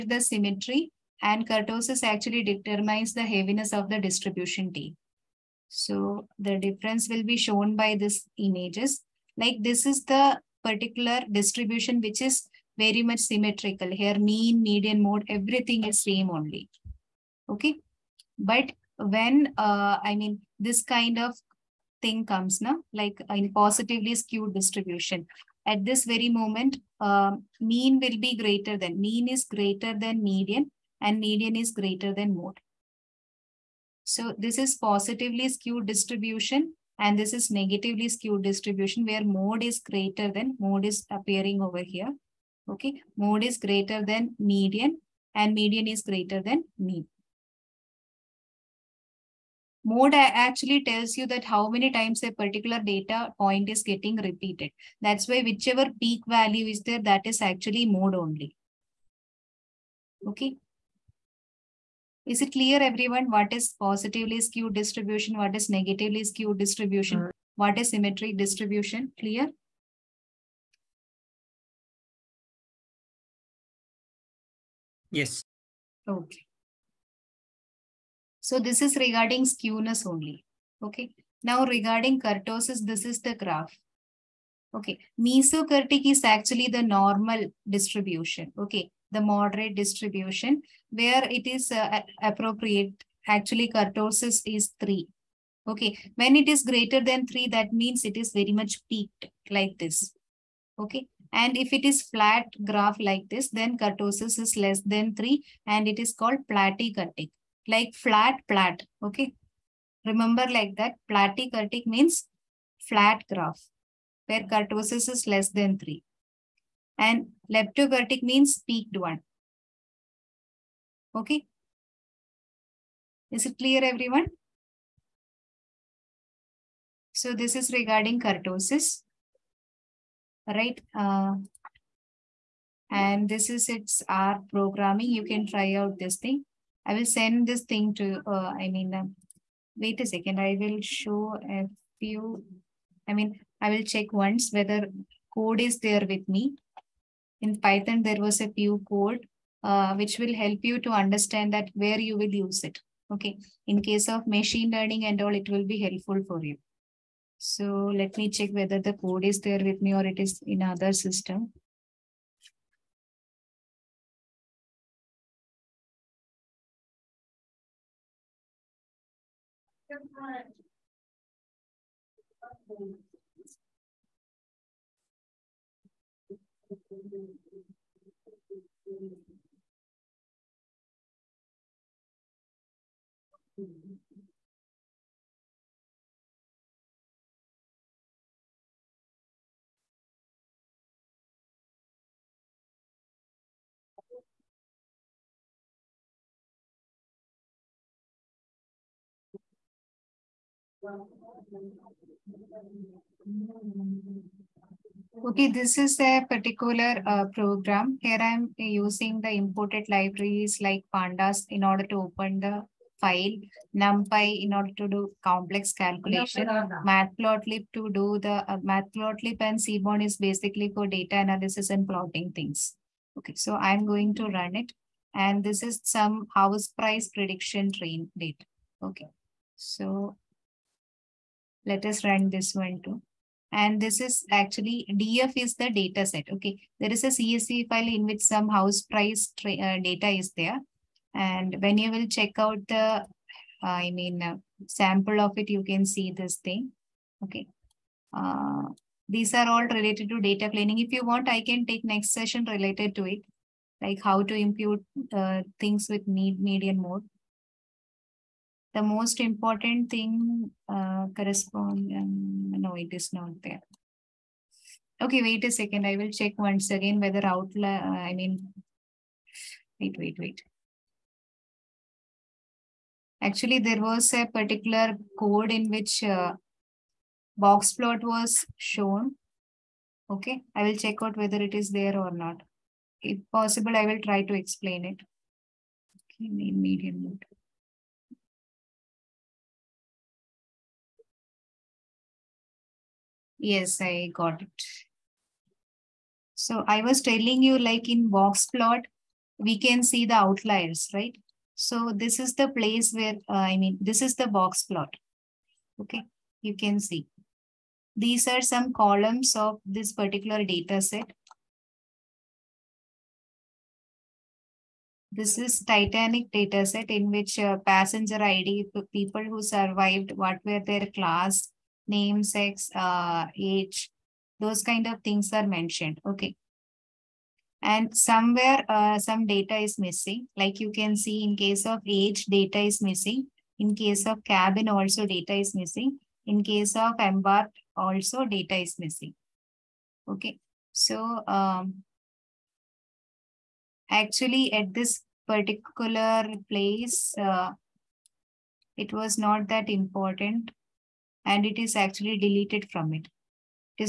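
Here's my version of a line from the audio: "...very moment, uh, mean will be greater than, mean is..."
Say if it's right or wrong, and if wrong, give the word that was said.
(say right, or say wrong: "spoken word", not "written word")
right.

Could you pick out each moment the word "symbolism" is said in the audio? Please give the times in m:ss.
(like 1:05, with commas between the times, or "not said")
not said.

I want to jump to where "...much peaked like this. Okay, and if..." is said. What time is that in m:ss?
1:38.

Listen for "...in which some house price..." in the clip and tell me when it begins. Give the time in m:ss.
3:57.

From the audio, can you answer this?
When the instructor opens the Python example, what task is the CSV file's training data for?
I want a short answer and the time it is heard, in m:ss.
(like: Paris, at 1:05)
House price prediction, at 3:46.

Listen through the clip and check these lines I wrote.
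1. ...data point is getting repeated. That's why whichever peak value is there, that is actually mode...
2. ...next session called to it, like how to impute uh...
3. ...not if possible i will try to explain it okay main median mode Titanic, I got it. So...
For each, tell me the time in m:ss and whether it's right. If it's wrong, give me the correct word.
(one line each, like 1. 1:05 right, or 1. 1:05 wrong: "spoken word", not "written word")
1. 0:52 right
2. 4:11 wrong: "related", not "called"
3. 4:42 wrong: "Yes", not "Titanic".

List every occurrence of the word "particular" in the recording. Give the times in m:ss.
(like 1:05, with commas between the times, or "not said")
0:10, 0:52, 3:26, 4:34, 5:09, 5:45.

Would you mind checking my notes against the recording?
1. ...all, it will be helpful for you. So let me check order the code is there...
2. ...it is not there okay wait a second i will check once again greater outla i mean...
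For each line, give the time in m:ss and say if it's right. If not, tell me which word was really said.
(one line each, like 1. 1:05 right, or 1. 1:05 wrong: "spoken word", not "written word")
1. 2:35 wrong: "whether", not "order"
2. 4:22 wrong: "whether", not "greater".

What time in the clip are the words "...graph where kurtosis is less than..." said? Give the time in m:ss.
1:53.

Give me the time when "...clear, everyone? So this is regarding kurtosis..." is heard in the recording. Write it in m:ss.
2:03.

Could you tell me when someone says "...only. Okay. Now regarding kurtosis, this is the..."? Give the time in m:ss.
1:20.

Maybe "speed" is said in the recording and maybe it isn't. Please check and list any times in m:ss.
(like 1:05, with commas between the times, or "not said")
not said.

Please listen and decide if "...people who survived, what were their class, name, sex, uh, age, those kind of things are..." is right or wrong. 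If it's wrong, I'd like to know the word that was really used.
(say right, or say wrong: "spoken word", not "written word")
right.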